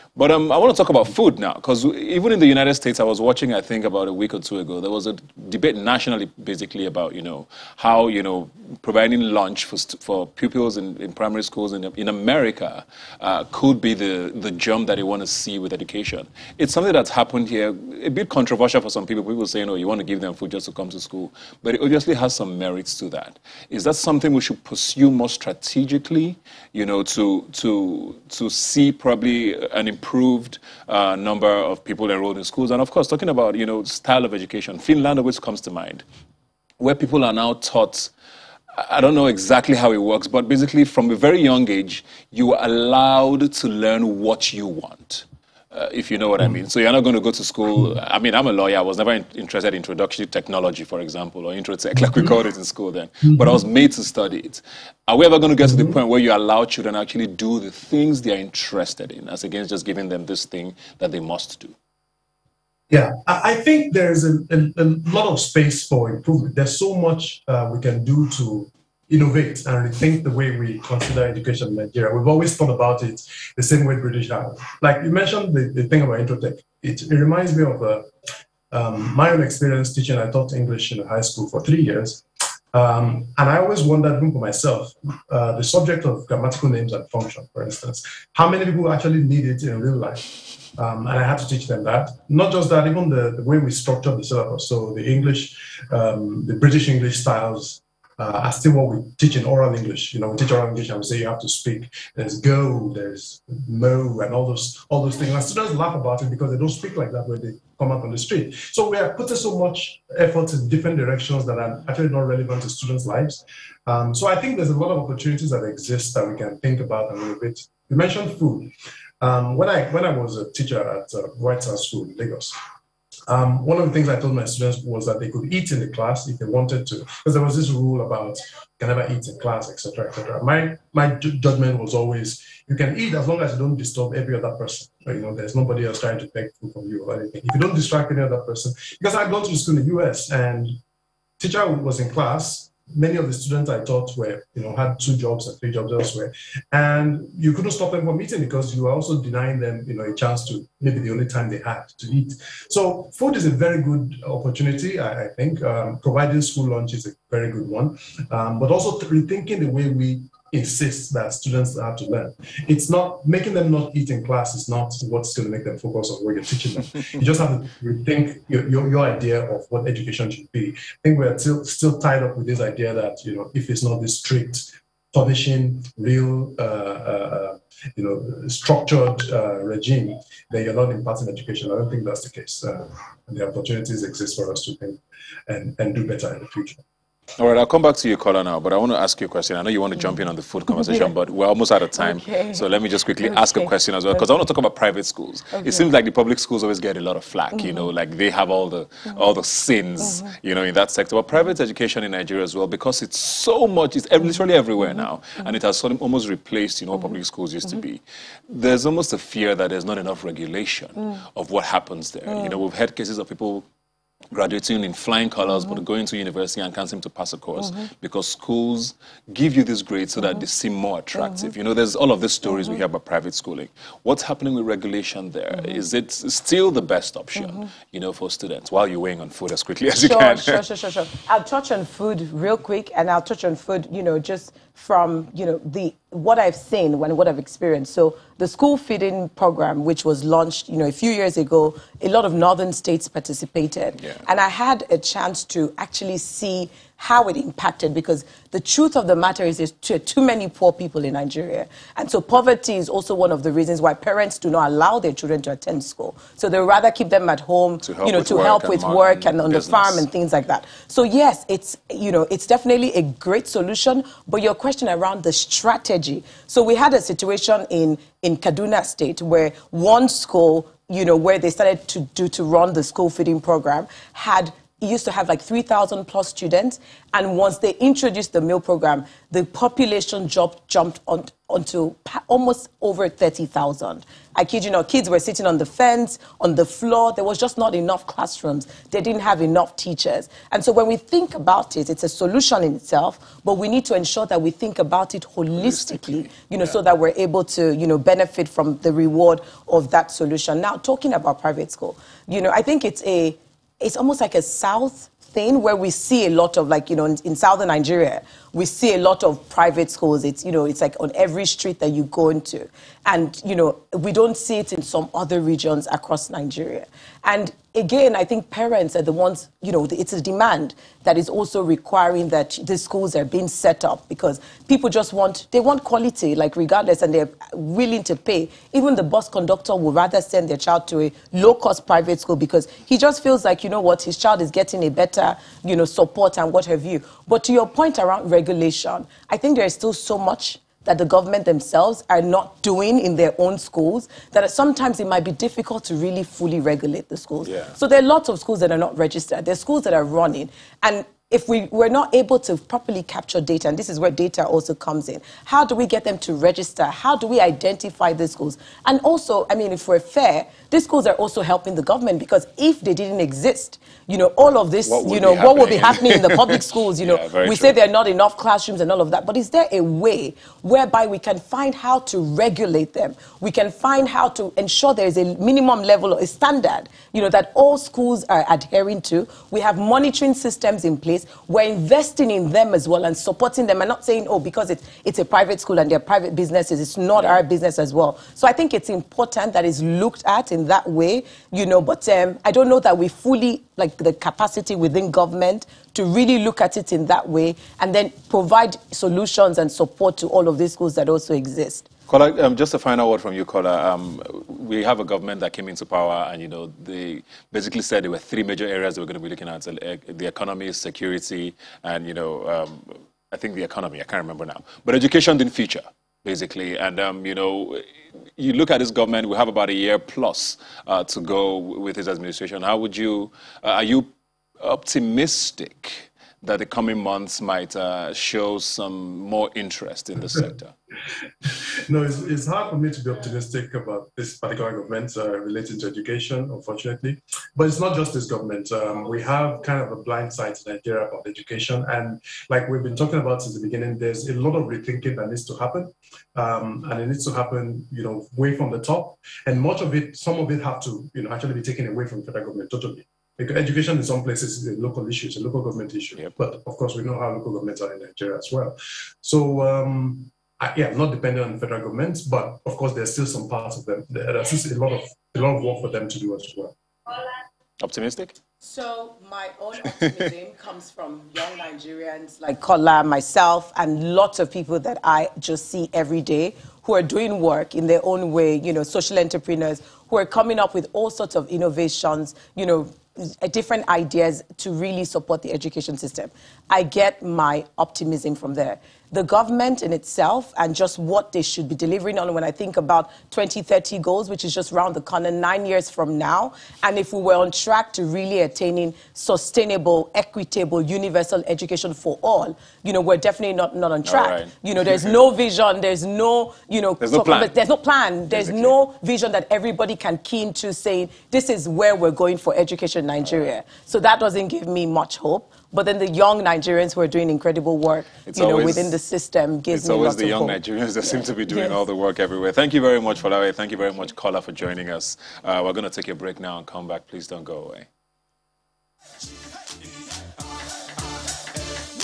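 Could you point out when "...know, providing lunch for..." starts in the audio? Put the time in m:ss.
0:08.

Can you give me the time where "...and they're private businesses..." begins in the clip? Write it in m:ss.
6:25.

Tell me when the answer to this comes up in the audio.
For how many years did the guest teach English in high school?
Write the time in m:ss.
1:21.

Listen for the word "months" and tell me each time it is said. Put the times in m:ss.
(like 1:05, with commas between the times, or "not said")
7:07.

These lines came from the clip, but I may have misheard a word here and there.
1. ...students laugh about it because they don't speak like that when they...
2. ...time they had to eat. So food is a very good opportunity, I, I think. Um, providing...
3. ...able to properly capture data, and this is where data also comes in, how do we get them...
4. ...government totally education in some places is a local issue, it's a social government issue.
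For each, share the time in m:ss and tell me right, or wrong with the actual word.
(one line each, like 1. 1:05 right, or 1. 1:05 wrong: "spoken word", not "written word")
1. 1:45 right
2. 2:31 right
3. 5:52 right
4. 7:32 wrong: "local", not "social".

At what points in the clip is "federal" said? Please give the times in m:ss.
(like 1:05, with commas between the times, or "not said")
7:32, 7:41.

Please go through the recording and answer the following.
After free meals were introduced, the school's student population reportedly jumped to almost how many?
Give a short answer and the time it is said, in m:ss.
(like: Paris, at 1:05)
30,000, at 4:43.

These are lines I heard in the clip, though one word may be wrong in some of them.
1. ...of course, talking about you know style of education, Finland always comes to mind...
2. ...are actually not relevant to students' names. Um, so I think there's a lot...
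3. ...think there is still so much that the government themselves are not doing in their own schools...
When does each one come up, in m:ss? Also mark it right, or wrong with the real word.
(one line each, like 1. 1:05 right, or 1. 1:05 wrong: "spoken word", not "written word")
1. 0:32 right
2. 1:51 wrong: "lives", not "names"
3. 5:39 right.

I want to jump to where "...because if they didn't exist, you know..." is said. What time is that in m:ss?
6:02.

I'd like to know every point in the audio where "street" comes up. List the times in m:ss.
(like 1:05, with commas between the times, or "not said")
1:48, 5:11.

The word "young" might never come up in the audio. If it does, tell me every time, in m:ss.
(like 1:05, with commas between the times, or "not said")
0:41, 7:51, 8:36, 8:40.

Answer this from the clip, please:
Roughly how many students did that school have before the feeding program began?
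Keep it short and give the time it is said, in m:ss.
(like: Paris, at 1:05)
3,000, at 4:35.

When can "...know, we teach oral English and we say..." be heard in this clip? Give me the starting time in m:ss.
1:40.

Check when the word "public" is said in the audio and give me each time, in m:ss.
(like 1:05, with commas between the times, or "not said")
3:16, 3:26, 6:06.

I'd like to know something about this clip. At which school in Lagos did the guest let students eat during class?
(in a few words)
White House School.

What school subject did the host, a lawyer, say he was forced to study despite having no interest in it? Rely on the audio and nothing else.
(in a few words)
Introductory technology.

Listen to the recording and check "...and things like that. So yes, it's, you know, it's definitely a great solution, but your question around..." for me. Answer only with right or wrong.
right.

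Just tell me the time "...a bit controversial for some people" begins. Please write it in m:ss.
0:18.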